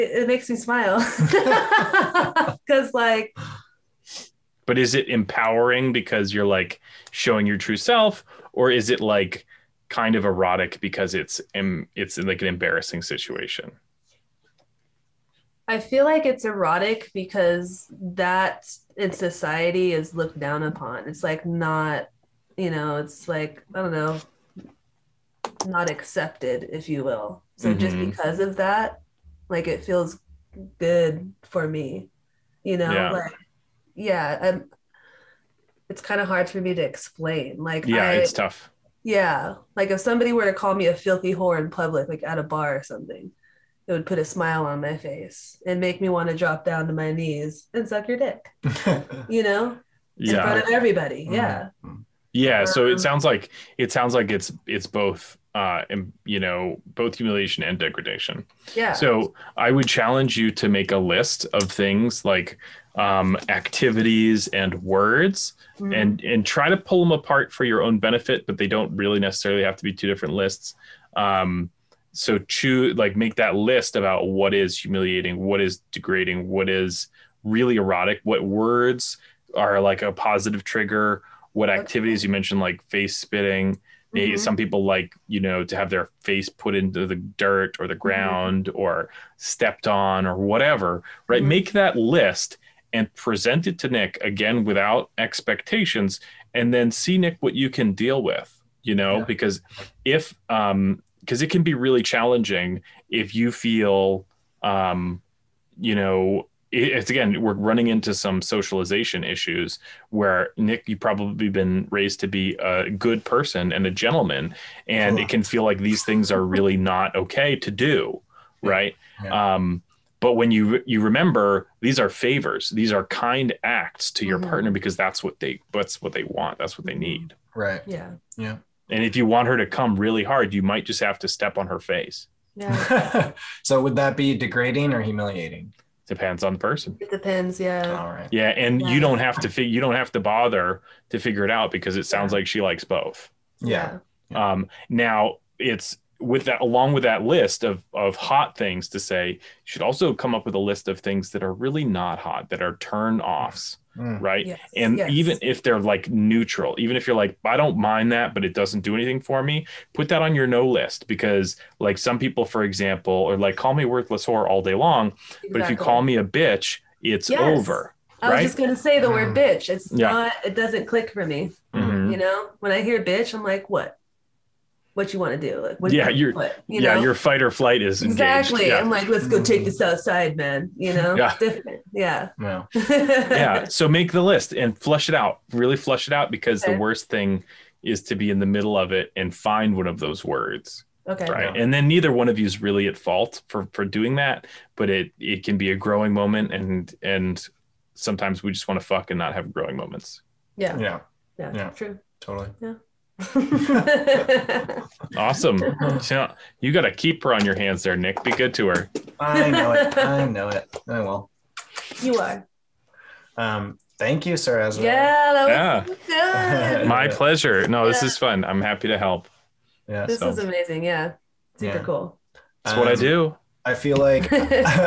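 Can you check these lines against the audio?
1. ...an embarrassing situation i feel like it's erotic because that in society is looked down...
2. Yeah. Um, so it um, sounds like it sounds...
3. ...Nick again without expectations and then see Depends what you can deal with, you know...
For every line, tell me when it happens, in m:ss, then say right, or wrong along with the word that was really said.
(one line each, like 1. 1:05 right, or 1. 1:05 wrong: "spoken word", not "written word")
1. 0:12 right
2. 0:52 right
3. 1:33 wrong: "Nick", not "Depends".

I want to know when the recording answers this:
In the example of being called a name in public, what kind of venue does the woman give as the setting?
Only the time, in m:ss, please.
0:42.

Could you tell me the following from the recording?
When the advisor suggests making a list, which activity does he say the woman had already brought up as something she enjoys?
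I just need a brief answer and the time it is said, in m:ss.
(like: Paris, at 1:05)
face spitting, at 1:22.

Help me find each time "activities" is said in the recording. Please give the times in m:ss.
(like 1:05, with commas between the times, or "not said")
1:03, 1:21.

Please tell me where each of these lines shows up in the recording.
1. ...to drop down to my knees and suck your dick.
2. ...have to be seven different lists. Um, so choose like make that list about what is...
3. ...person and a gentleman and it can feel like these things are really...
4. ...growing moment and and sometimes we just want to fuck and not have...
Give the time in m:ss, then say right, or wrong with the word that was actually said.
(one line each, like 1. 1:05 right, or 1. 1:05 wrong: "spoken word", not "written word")
1. 0:46 right
2. 1:09 wrong: "two", not "seven"
3. 1:53 right
4. 3:15 right.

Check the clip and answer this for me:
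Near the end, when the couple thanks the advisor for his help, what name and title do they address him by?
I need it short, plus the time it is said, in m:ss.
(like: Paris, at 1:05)
Sir Ezra, at 3:34.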